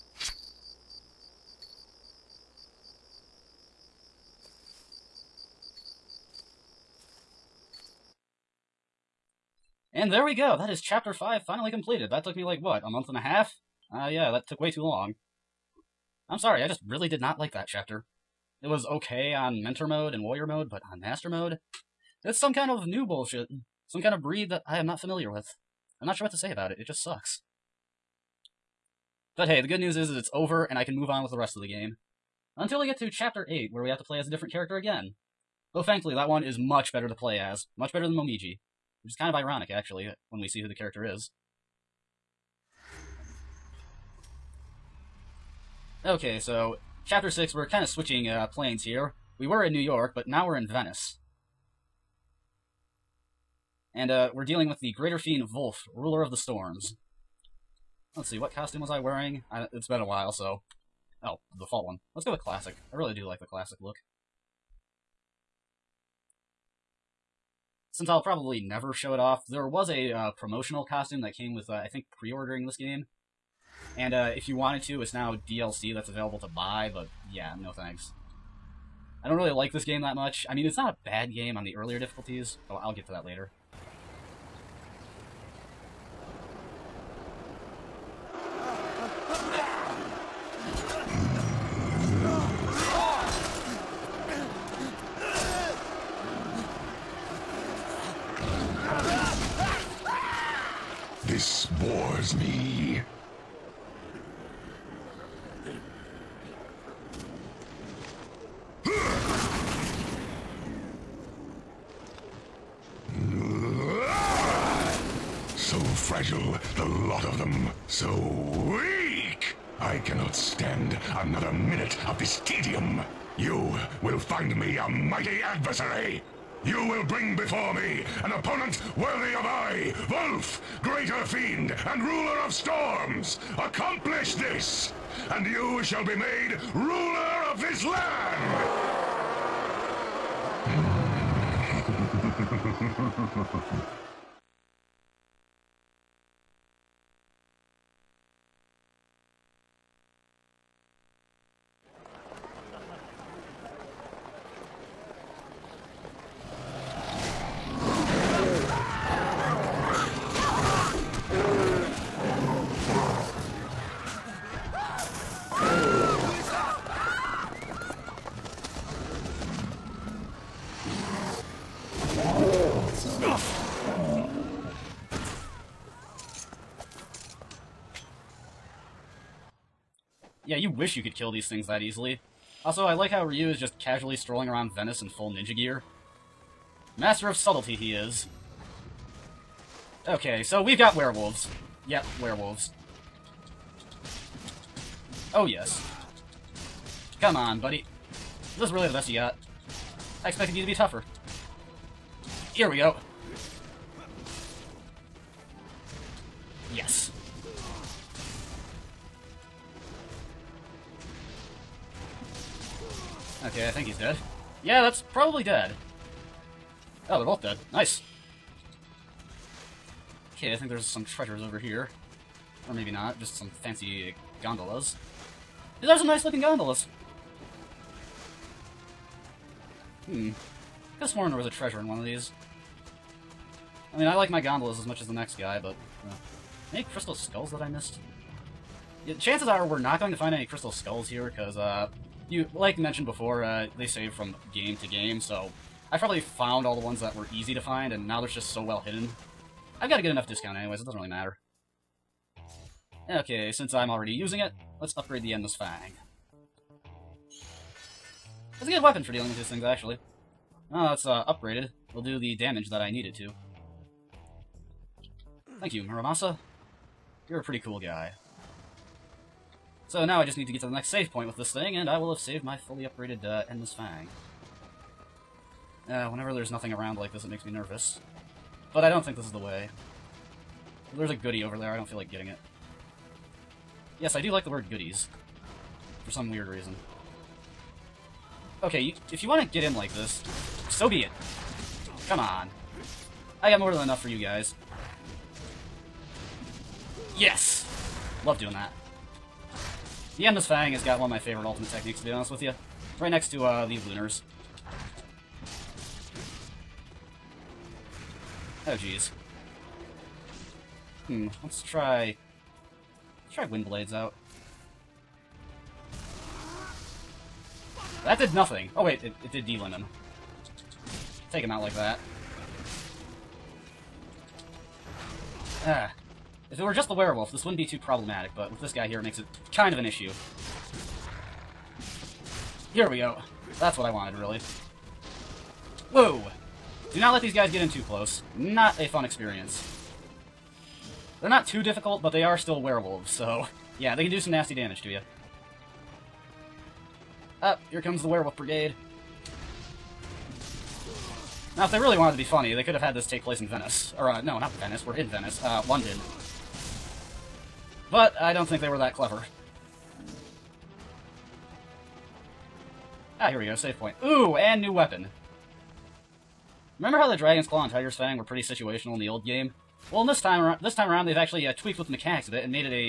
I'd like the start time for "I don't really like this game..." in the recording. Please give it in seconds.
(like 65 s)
79 s.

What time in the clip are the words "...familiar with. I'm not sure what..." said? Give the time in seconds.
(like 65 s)
24 s.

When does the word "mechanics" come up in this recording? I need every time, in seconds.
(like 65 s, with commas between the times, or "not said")
371 s.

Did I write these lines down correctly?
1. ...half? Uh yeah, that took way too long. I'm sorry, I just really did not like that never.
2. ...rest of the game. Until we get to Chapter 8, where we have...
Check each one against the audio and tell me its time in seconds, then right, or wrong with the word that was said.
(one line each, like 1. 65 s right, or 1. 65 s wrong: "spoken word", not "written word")
1. 13 s wrong: "chapter", not "never"
2. 31 s right.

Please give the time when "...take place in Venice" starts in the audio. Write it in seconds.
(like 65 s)
353 s.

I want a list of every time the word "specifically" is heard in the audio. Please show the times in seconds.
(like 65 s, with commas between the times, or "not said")
not said.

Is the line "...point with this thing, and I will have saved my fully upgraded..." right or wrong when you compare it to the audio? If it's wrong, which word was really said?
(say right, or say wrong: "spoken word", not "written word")
right.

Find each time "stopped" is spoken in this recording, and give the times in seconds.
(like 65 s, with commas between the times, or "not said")
not said.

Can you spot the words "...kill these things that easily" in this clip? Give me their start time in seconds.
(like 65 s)
181 s.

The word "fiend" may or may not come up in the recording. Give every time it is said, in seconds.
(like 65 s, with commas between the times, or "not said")
55 s, 131 s.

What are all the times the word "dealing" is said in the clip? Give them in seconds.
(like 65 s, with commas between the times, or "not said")
54 s, 259 s.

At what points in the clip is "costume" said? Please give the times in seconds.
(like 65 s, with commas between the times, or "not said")
58 s, 70 s.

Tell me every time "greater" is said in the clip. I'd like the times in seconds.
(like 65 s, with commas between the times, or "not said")
54 s, 130 s.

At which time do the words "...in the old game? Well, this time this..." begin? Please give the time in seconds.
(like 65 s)
368 s.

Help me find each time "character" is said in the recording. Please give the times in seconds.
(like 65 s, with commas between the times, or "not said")
34 s, 40 s.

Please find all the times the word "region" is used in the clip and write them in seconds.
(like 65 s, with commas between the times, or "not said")
not said.